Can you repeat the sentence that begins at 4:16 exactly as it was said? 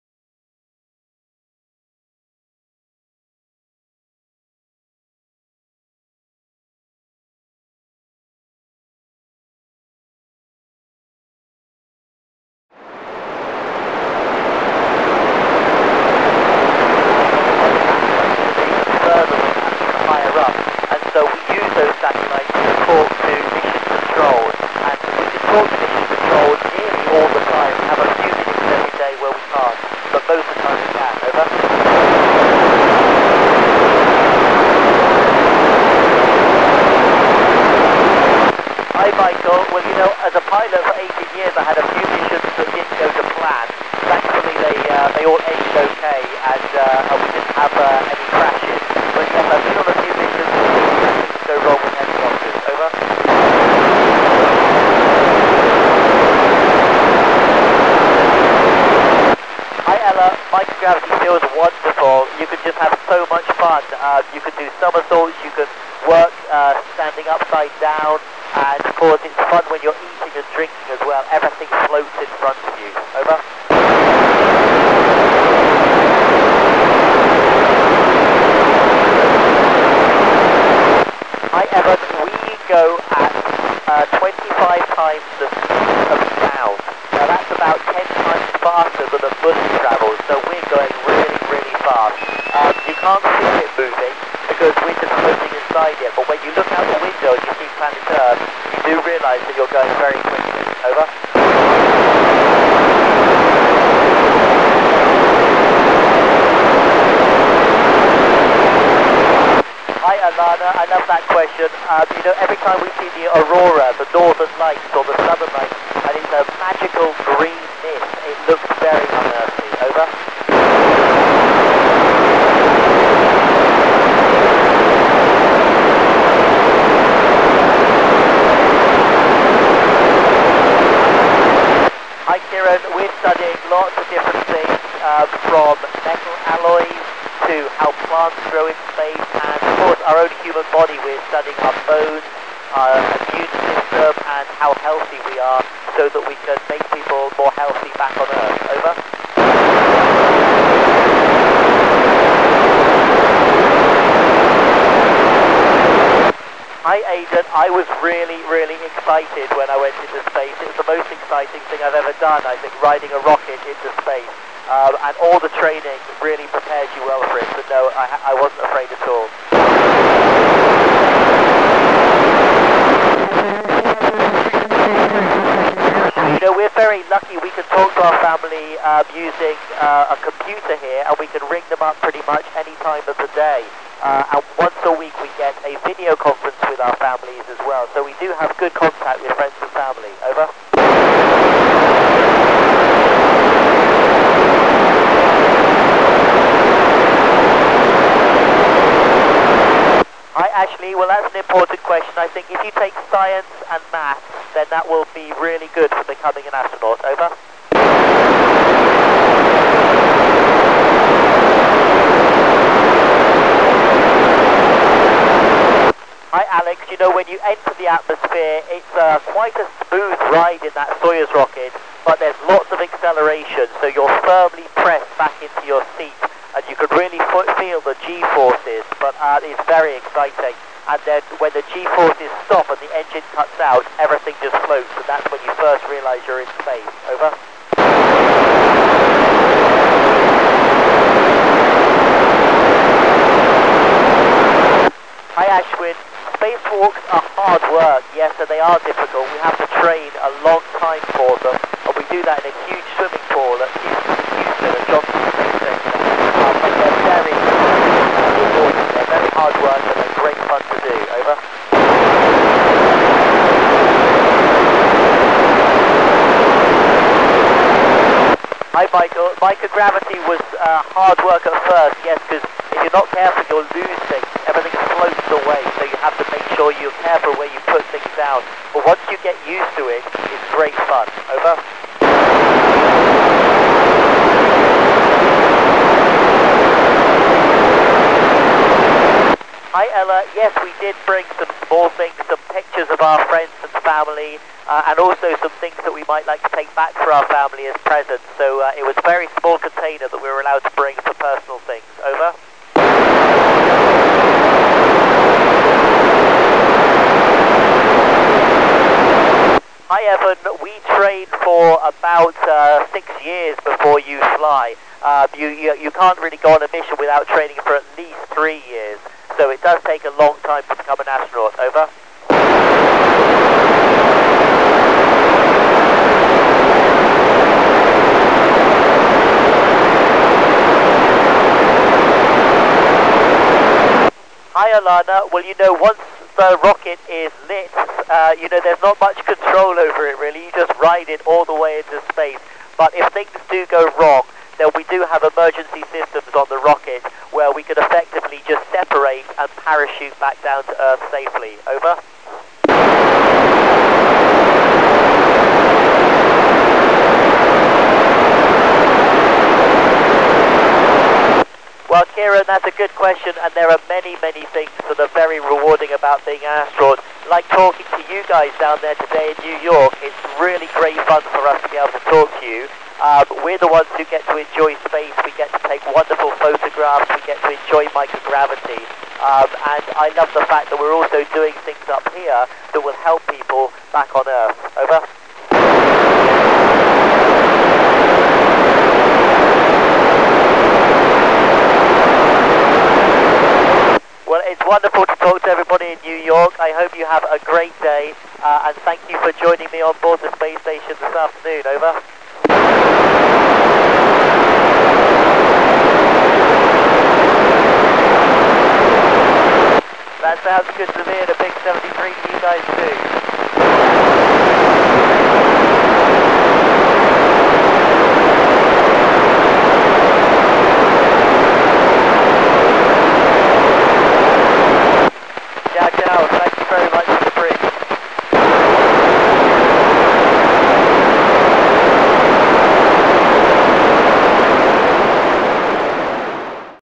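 Um, and they're very They're very hard work, and they're great fun to do.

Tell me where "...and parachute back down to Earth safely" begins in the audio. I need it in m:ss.
5:49.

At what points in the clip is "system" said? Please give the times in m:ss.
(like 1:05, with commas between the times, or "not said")
2:23, 5:45.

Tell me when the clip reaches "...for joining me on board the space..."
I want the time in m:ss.
6:39.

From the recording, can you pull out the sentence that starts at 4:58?
So uh, it was a very small container that we were allowed to bring about uh, six years before you fly.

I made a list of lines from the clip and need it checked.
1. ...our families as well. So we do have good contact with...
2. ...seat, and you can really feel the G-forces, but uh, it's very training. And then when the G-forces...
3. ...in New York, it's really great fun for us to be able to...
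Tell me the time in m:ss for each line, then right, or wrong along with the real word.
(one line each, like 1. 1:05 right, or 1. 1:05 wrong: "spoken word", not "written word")
1. 3:06 right
2. 3:45 wrong: "exciting", not "training"
3. 6:09 right.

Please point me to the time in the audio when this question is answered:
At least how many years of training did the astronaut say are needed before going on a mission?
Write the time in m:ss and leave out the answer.
5:18.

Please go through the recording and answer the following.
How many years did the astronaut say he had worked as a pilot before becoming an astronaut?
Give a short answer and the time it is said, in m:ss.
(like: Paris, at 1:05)
18, at 0:40.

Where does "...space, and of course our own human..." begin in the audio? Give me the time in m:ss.
2:18.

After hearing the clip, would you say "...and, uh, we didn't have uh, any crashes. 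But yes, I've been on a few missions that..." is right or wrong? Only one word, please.
right.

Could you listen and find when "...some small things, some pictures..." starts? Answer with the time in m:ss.
4:51.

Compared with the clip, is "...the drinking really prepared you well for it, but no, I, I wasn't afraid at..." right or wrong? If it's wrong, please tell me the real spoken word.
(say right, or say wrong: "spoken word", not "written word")
wrong: "training", not "drinking".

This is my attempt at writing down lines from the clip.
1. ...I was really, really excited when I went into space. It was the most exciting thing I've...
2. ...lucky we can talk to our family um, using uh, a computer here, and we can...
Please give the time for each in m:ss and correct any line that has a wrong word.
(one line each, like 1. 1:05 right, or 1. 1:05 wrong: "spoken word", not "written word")
1. 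2:37 right
2. 2:57 right.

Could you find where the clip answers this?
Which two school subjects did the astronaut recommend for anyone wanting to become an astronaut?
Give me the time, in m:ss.
3:23.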